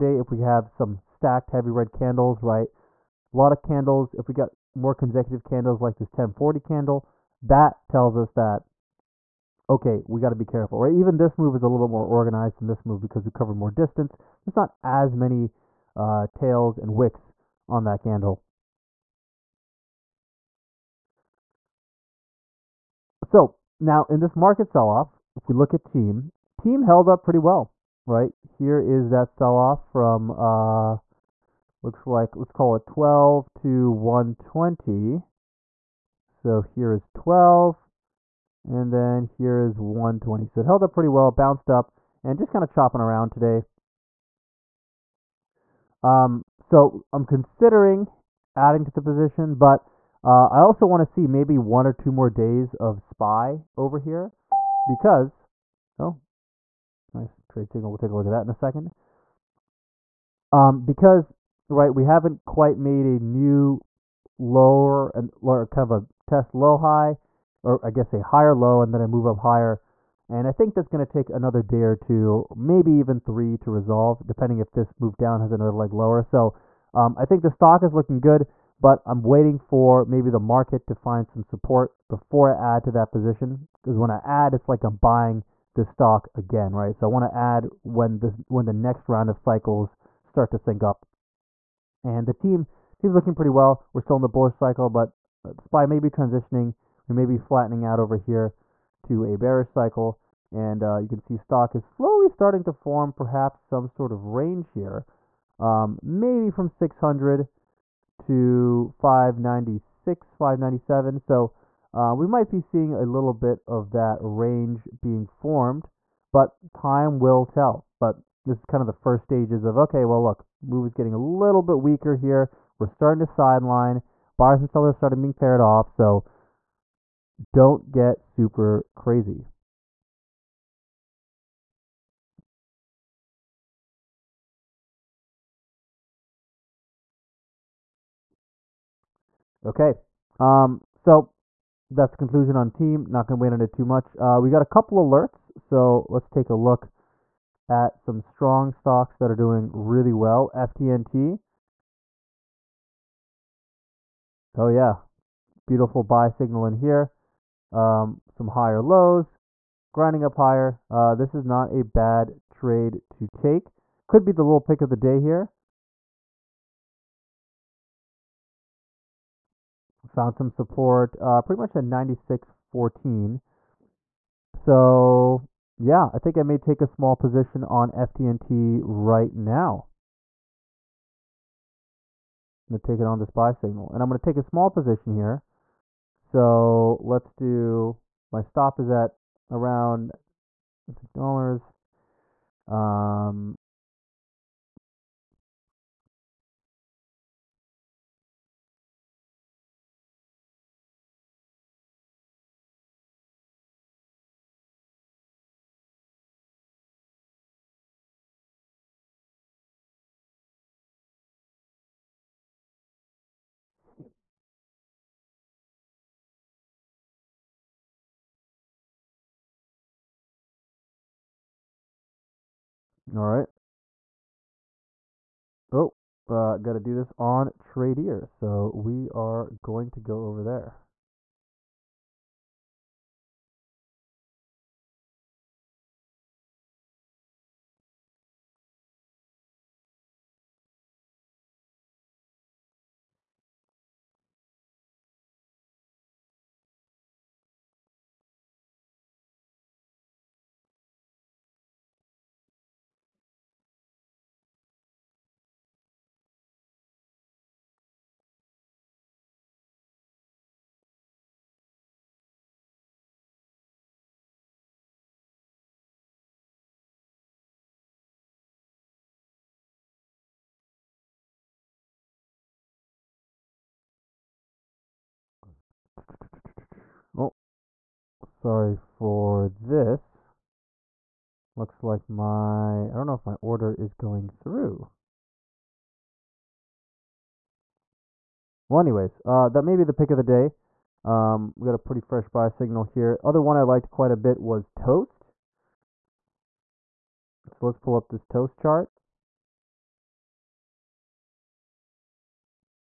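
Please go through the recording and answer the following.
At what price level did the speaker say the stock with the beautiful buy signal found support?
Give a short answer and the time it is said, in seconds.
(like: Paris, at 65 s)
96.14, at 171 s.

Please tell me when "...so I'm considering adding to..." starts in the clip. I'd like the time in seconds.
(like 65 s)
46 s.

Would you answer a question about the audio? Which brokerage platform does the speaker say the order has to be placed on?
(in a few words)
Tradier.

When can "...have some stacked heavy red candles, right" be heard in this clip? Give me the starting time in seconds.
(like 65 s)
0 s.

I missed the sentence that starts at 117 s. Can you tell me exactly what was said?
But this is kind of the first stages of okay, well, look, move is getting a little bit weaker here.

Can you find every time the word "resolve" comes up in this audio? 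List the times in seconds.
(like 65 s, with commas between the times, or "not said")
73 s.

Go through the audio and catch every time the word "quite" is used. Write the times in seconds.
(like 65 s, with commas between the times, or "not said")
62 s, 293 s.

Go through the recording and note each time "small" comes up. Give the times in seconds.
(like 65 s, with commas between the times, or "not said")
176 s, 184 s.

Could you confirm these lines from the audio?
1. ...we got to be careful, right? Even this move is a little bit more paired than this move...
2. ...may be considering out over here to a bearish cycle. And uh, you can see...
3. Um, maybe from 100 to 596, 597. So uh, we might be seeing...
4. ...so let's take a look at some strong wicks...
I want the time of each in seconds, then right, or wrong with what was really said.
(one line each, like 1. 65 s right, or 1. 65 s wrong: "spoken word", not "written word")
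1. 10 s wrong: "organized", not "paired"
2. 97 s wrong: "flattening", not "considering"
3. 105 s wrong: "600", not "100"
4. 145 s wrong: "stocks", not "wicks".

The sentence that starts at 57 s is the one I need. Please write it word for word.
We'll take a look at that in a second.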